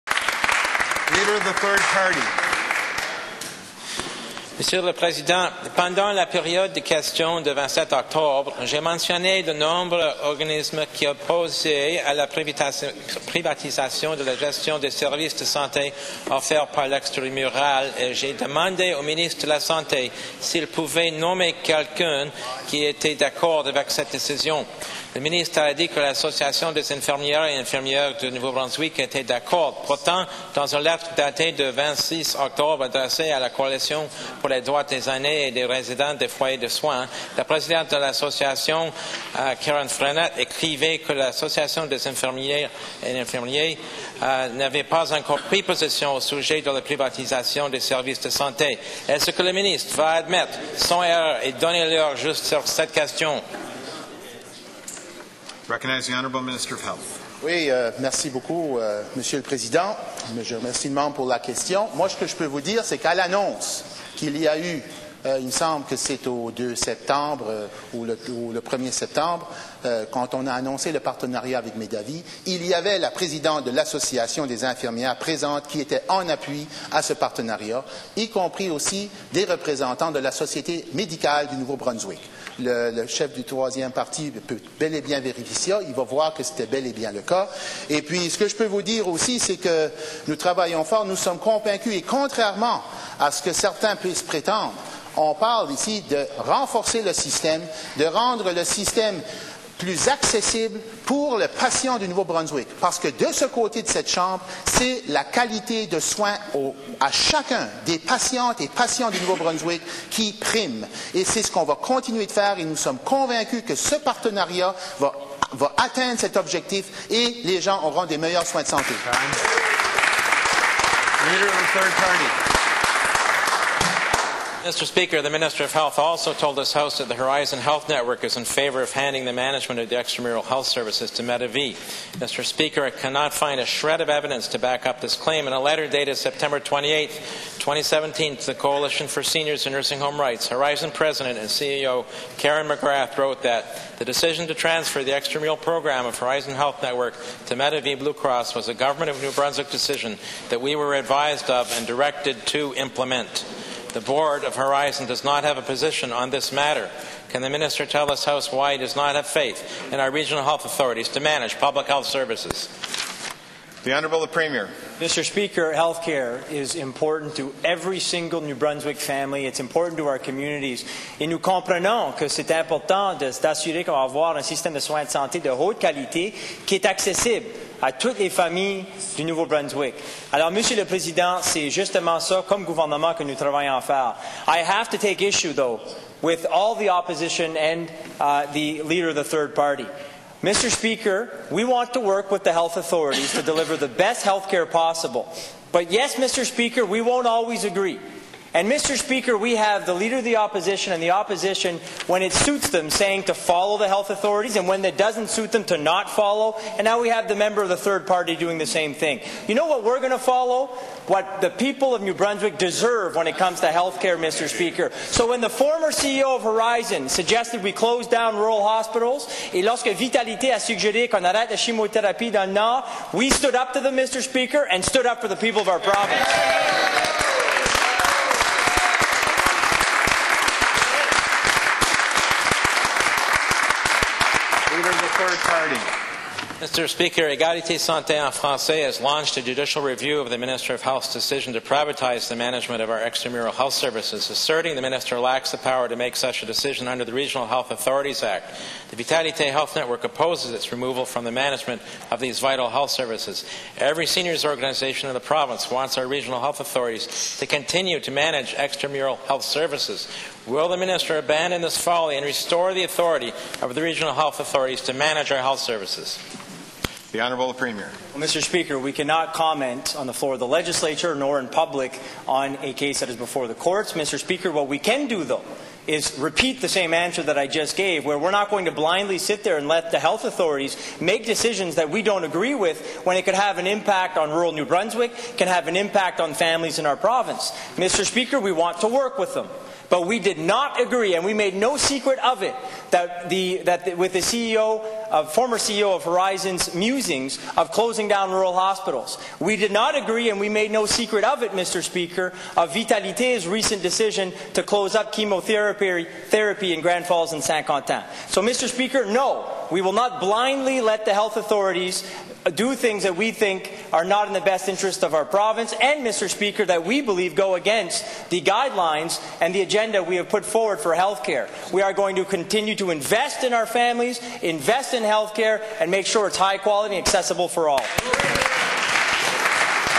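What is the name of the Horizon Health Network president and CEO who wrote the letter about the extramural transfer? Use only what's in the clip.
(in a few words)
Karen McGrath.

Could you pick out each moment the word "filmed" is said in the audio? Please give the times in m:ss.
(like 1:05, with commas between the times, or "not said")
not said.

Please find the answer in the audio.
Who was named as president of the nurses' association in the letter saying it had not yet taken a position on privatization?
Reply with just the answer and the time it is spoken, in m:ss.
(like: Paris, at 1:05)
Karen Frenette, at 0:39.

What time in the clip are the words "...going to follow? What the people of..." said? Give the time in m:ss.
3:29.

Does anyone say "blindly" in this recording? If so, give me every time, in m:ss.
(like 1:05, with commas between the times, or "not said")
4:38, 5:10.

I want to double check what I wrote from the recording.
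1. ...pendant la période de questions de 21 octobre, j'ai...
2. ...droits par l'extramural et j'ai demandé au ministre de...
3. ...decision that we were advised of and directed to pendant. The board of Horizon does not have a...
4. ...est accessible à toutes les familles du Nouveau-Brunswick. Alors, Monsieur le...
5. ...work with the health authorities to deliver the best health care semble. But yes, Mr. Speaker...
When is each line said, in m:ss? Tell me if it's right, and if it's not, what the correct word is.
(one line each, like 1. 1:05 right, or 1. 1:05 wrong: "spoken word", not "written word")
1. 0:05 wrong: "27", not "21"
2. 0:16 wrong: "offerts", not "droits"
3. 2:29 wrong: "implement", not "pendant"
4. 2:56 right
5. 3:11 wrong: "possible", not "semble".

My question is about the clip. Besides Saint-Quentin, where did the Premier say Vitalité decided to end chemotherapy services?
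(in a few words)
Grand Falls.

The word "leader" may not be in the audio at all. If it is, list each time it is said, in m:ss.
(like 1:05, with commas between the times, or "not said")
0:01, 3:08, 3:19.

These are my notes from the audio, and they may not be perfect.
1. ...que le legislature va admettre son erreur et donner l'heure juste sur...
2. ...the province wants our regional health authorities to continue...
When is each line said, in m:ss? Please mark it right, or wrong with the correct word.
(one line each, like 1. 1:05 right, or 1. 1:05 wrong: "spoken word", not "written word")
1. 0:49 wrong: "ministre", not "legislature"
2. 4:15 right.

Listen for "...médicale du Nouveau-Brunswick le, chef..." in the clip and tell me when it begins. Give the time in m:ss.
1:20.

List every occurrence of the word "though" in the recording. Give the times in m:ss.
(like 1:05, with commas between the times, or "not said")
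3:05, 4:35.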